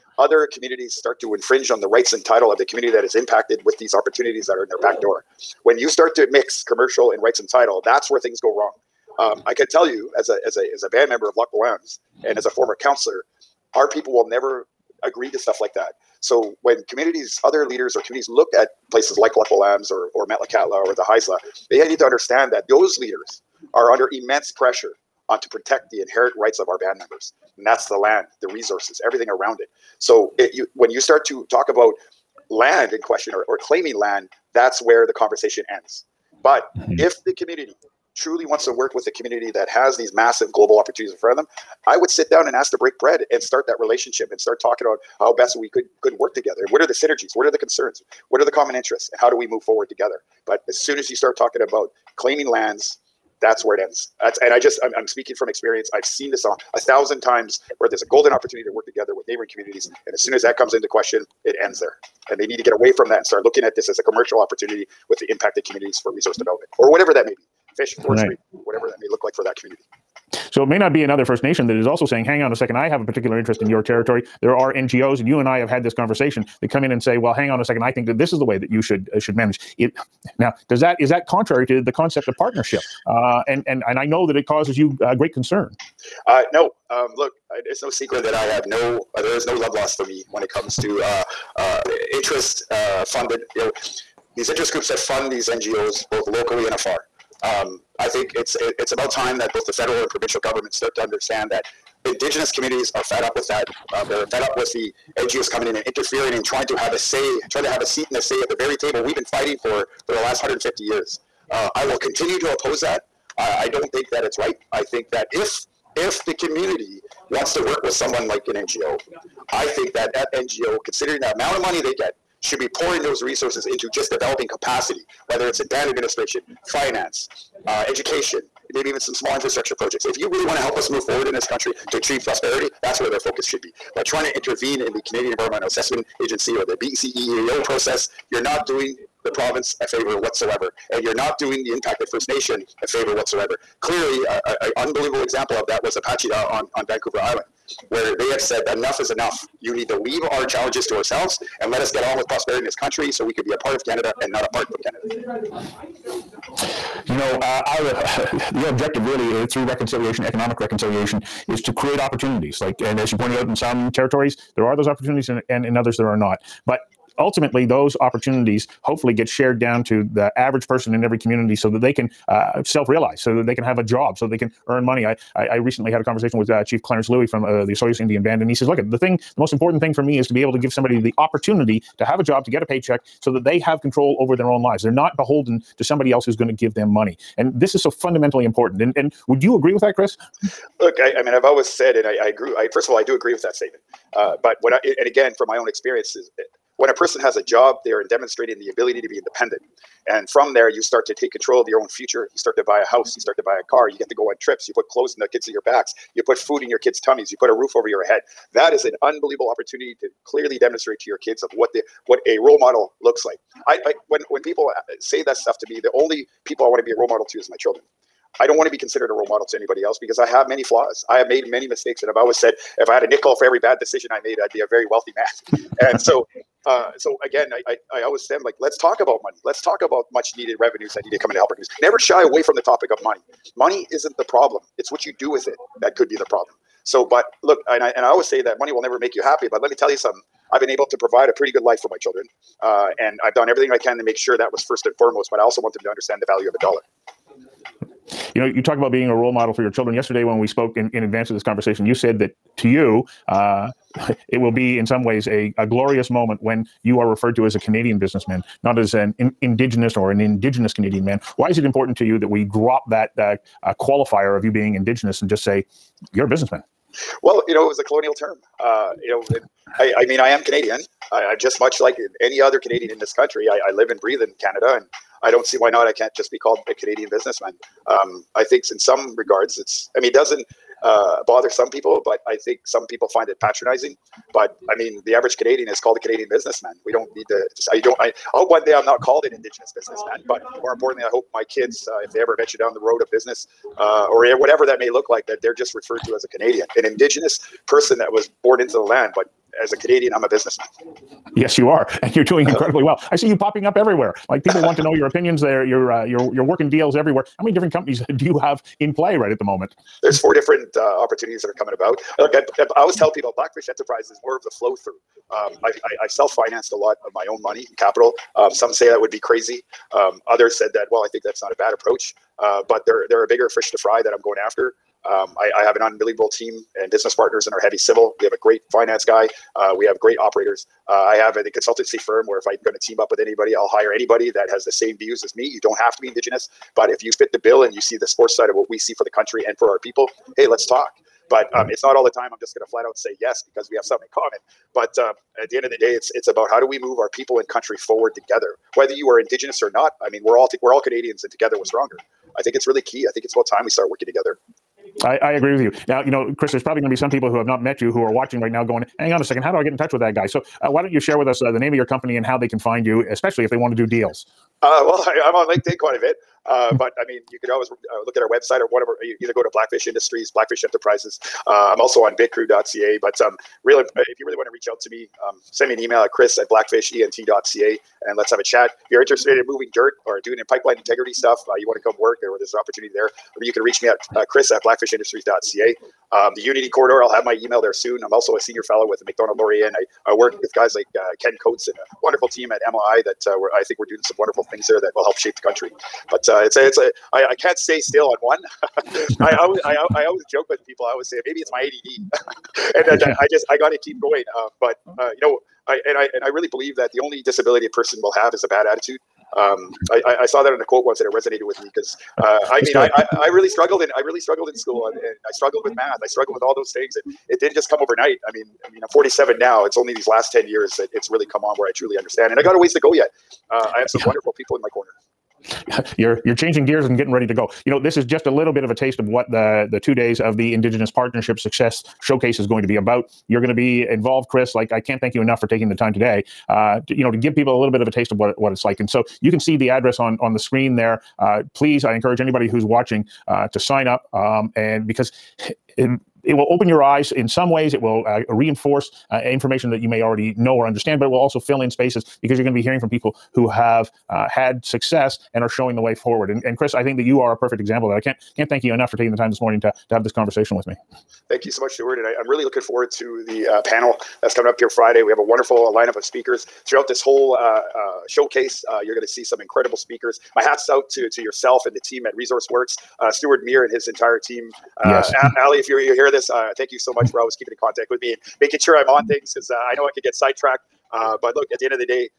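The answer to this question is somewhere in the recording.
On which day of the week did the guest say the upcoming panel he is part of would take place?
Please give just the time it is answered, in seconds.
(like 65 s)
464 s.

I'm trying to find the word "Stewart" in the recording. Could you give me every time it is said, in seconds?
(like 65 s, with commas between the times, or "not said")
461 s, 473 s.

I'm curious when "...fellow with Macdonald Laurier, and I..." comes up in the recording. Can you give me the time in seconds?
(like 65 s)
388 s.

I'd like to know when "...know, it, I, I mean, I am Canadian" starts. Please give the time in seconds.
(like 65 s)
269 s.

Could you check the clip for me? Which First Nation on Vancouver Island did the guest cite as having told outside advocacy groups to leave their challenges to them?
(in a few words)
Pacheedaht.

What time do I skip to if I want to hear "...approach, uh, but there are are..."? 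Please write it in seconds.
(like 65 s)
321 s.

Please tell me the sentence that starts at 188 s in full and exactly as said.
And and would you agree with that, Chris?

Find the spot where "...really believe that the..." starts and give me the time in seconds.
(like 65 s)
406 s.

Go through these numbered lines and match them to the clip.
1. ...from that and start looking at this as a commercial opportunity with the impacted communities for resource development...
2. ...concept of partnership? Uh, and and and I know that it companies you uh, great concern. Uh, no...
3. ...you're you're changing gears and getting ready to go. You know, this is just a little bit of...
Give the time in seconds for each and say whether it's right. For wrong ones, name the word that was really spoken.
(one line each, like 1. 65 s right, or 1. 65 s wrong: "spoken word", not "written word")
1. 62 s right
2. 81 s wrong: "causes", not "companies"
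3. 425 s right.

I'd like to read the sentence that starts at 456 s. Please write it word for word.
And, and Chris, I think that you are a perfect example of that.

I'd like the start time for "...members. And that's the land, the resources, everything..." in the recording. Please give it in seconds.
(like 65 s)
26 s.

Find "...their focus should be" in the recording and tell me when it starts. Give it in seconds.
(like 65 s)
133 s.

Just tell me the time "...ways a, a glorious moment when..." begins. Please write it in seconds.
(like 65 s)
255 s.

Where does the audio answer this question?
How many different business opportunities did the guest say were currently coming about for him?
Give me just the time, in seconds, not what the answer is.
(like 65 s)
310 s.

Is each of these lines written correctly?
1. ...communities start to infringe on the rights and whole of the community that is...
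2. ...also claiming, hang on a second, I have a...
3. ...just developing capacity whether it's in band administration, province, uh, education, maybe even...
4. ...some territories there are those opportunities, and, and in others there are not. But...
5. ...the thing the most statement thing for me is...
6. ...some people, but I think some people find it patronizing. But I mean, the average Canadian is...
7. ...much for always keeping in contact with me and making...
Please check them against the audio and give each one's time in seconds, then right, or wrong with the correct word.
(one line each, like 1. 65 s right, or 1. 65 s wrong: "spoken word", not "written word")
1. 0 s wrong: "title", not "whole"
2. 71 s wrong: "saying", not "claiming"
3. 123 s wrong: "finance", not "province"
4. 163 s right
5. 178 s wrong: "important", not "statement"
6. 281 s right
7. 476 s right.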